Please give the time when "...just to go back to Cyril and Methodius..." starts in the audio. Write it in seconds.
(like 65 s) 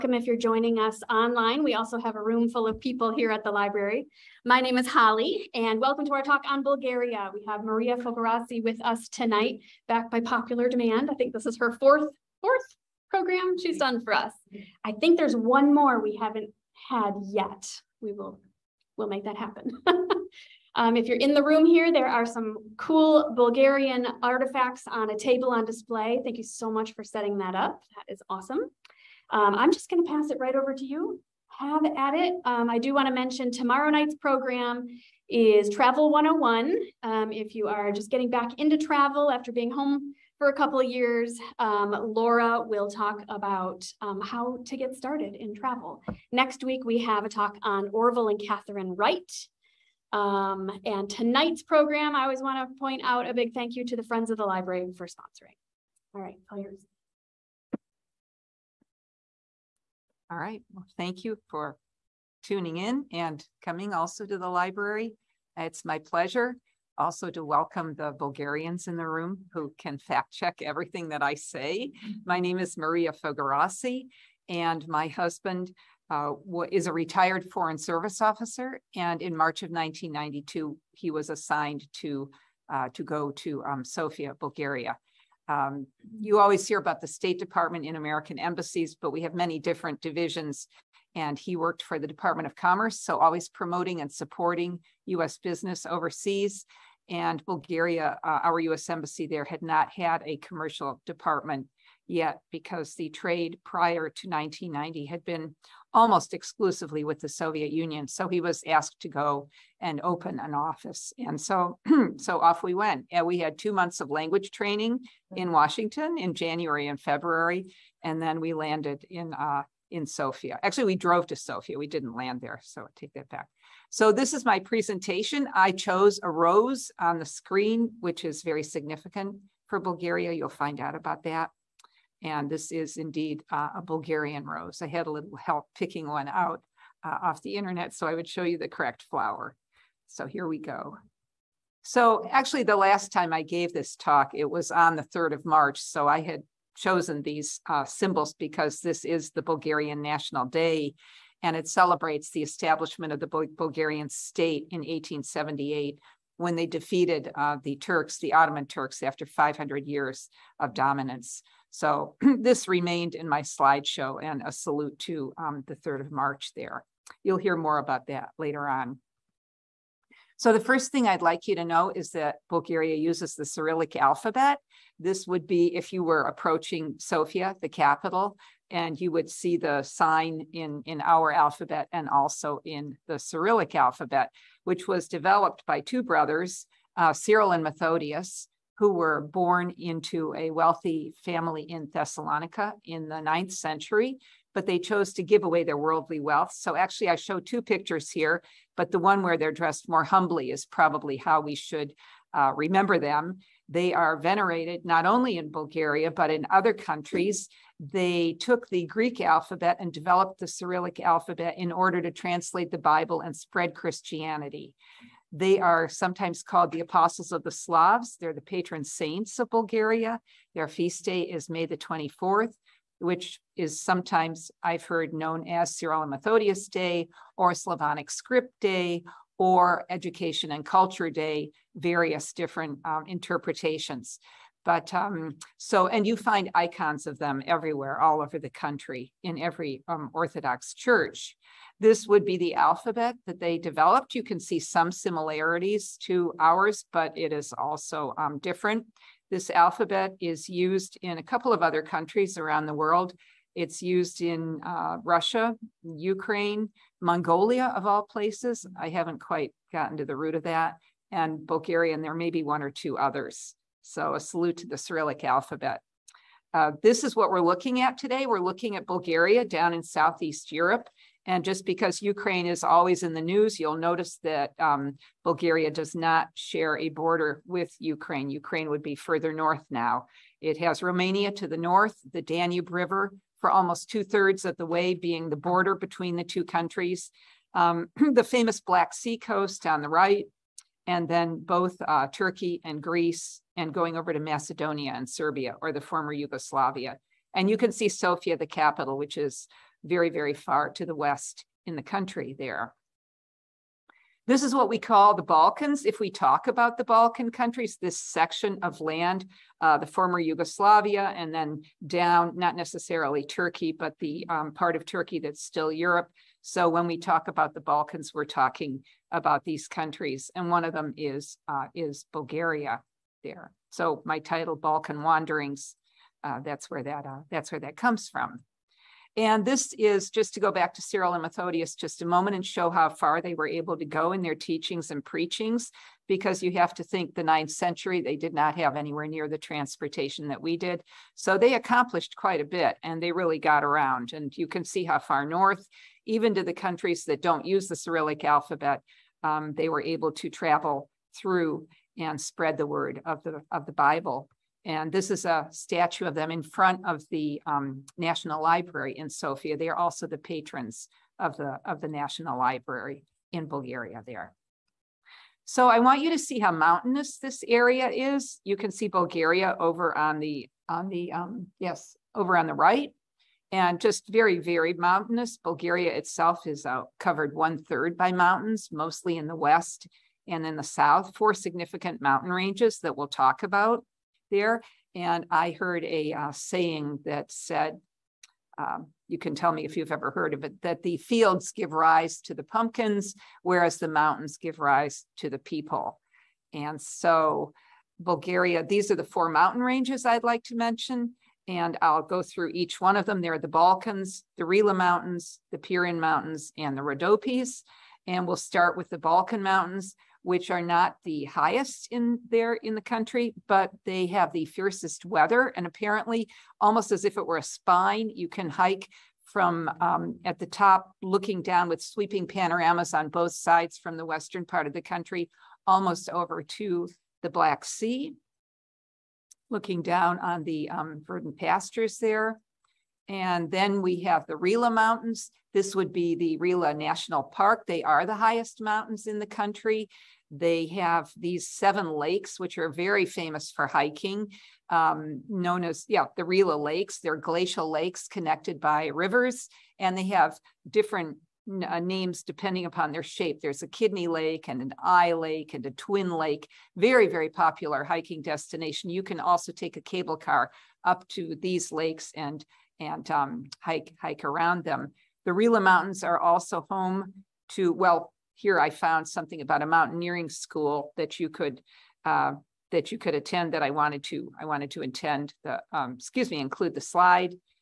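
330 s.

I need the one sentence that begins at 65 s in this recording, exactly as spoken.
It's my pleasure also to welcome the Bulgarians in the room who can fact check everything that I say.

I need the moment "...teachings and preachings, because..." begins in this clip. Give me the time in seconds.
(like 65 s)
334 s.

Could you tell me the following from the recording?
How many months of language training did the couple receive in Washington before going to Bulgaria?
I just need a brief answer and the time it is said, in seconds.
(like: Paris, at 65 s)
2, at 113 s.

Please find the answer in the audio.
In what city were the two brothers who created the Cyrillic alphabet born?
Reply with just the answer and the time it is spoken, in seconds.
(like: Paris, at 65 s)
Thessalonica, at 191 s.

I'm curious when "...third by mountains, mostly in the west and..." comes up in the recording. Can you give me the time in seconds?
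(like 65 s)
377 s.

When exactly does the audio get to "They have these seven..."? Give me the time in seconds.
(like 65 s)
440 s.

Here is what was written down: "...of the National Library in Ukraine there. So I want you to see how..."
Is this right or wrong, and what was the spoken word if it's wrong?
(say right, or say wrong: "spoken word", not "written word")
wrong: "Bulgaria", not "Ukraine".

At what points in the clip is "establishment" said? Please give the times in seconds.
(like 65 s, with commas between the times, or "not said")
152 s.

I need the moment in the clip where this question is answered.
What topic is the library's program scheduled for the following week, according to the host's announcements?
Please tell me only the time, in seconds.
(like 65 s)
47 s.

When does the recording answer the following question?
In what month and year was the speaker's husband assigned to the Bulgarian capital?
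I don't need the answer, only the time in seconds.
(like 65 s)
79 s.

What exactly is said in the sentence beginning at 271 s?
And just because Ukraine is always in the news, you'll notice that um, Bulgaria does not share a border with Ukraine.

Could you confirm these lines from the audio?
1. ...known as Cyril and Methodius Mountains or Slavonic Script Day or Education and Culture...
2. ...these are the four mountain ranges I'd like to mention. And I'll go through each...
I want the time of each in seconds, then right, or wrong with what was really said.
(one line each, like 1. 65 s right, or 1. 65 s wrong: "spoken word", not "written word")
1. 225 s wrong: "Day", not "Mountains"
2. 398 s right.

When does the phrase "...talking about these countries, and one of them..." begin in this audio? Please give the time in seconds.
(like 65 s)
318 s.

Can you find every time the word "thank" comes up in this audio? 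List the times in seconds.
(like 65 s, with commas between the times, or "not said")
26 s, 53 s, 60 s.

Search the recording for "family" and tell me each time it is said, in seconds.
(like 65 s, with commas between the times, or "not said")
191 s.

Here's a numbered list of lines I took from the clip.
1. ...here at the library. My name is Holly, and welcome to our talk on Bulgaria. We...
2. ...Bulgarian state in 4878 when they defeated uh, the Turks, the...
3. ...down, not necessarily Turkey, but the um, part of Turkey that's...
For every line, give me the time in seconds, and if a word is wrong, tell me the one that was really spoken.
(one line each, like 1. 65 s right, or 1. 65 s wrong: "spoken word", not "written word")
1. 3 s right
2. 153 s wrong: "1878", not "4878"
3. 311 s right.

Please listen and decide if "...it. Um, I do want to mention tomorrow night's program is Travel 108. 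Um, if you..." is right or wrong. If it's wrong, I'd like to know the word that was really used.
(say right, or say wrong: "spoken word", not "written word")
wrong: "101", not "108".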